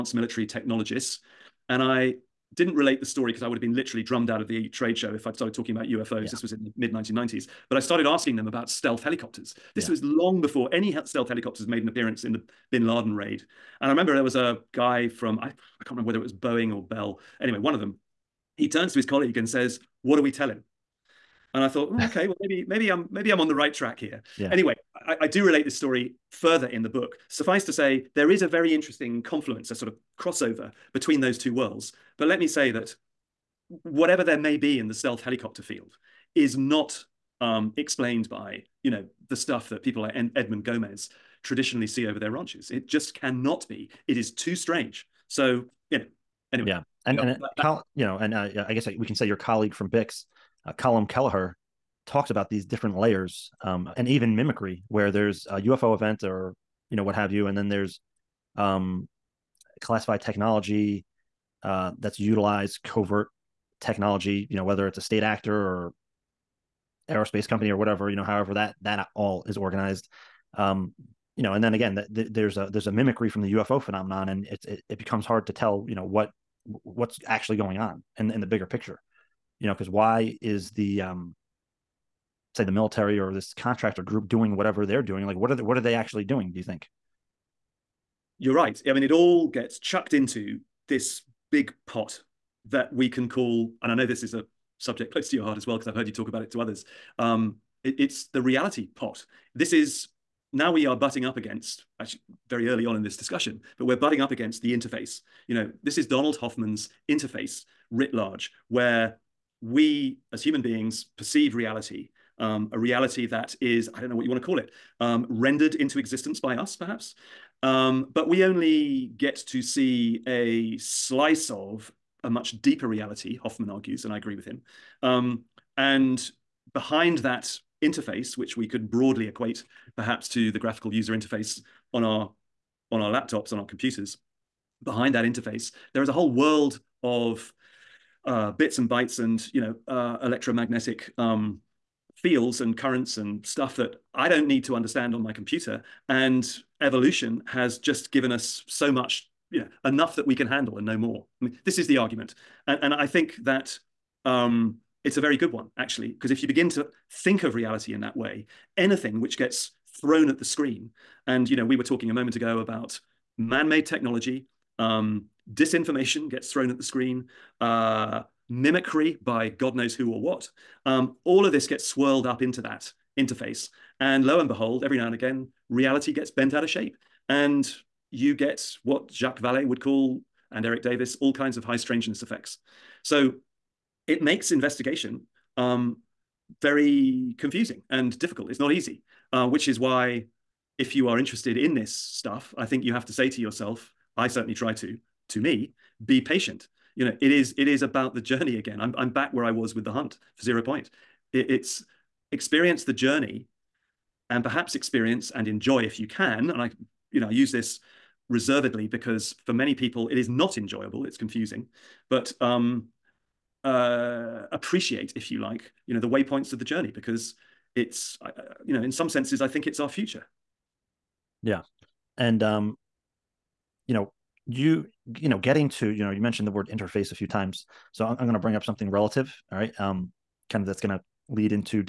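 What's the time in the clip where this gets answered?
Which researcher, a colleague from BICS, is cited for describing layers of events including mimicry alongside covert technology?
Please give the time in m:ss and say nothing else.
0:50.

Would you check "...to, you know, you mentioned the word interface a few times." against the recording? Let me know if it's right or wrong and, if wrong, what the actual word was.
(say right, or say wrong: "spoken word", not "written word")
right.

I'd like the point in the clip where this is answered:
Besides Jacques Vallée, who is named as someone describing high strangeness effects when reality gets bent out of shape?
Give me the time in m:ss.
3:00.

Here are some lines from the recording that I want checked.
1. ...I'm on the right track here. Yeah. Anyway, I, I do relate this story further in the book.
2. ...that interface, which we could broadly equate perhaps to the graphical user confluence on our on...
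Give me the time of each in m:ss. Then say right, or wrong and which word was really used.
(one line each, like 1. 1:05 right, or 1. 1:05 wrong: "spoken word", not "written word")
1. 0:23 right
2. 2:07 wrong: "interface", not "confluence".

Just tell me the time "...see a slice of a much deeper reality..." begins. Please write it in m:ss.
1:59.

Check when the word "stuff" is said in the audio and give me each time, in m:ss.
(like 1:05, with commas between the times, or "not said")
0:39, 2:23, 3:11.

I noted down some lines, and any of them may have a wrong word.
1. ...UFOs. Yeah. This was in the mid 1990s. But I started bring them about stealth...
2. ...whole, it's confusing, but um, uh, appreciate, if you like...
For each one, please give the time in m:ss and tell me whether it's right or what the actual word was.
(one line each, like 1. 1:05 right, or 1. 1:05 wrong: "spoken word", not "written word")
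1. 0:05 wrong: "asking", not "bring"
2. 3:30 wrong: "enjoyable", not "whole".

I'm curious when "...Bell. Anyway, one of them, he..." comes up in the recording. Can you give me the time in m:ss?
0:16.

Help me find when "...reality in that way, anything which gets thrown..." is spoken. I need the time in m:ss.
2:37.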